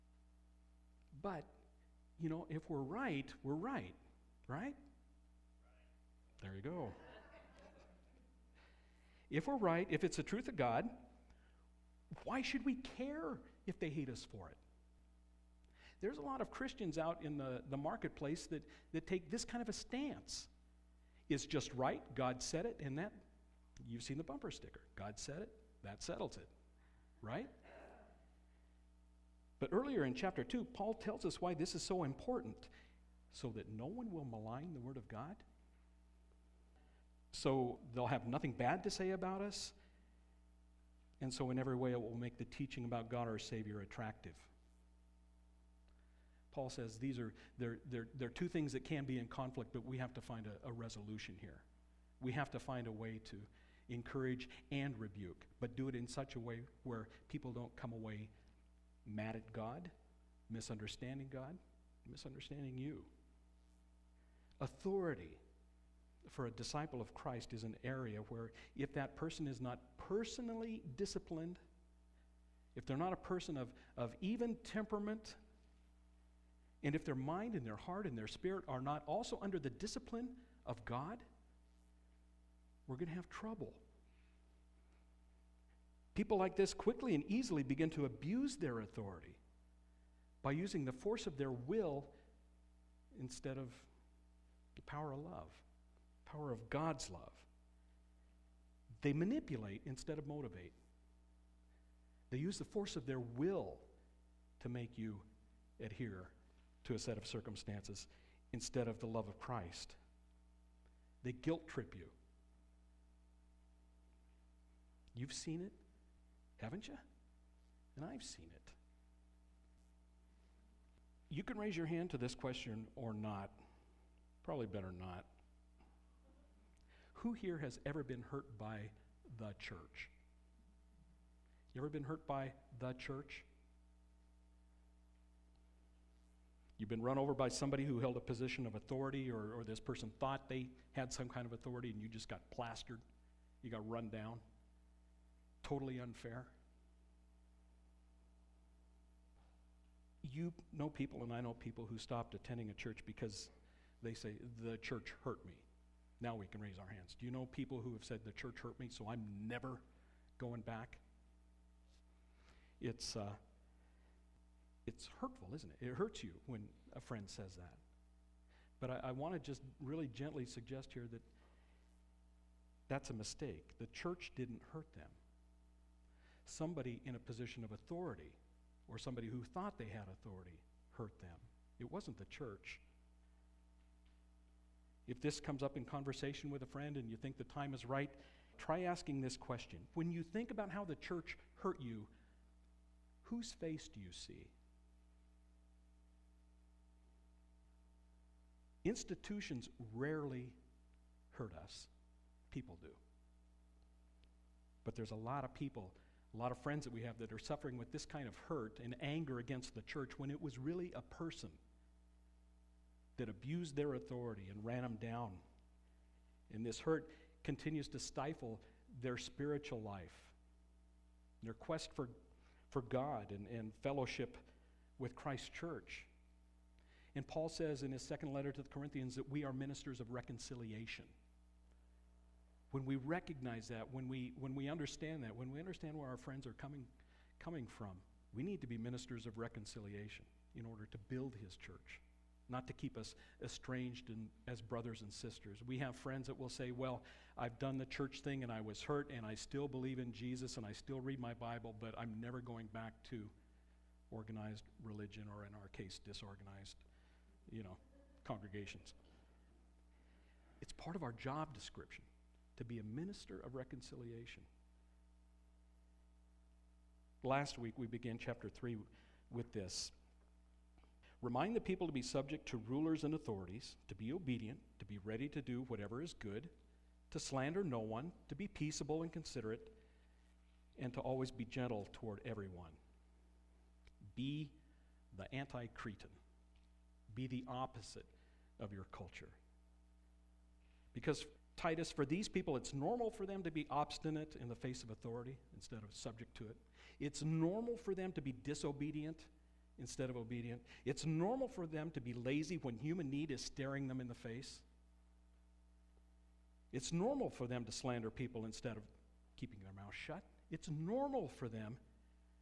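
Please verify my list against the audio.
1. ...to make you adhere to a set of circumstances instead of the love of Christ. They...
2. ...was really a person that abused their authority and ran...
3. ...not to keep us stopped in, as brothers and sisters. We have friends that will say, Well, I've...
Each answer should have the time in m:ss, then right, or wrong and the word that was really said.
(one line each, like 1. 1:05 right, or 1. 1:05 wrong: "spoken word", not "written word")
1. 1:44 right
2. 3:30 right
3. 4:02 wrong: "estranged", not "stopped".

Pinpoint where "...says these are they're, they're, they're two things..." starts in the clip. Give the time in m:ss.
0:46.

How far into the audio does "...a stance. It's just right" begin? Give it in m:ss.
0:19.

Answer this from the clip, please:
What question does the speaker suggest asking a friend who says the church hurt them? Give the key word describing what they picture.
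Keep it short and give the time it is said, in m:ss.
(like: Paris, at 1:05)
whose face, at 3:13.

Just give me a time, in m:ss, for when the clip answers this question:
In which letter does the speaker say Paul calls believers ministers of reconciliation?
3:48.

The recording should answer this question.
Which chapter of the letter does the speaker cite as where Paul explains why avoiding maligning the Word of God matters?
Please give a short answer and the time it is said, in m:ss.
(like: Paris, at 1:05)
chapter 2, at 0:30.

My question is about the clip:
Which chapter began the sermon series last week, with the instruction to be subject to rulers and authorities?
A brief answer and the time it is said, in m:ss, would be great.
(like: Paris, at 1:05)
chapter 3, at 4:28.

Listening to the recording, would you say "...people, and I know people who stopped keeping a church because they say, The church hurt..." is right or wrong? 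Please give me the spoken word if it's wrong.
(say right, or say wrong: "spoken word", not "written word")
wrong: "attending", not "keeping".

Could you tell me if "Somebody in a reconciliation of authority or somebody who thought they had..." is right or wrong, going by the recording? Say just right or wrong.
wrong.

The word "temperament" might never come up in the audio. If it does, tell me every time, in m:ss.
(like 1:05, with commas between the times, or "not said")
1:14.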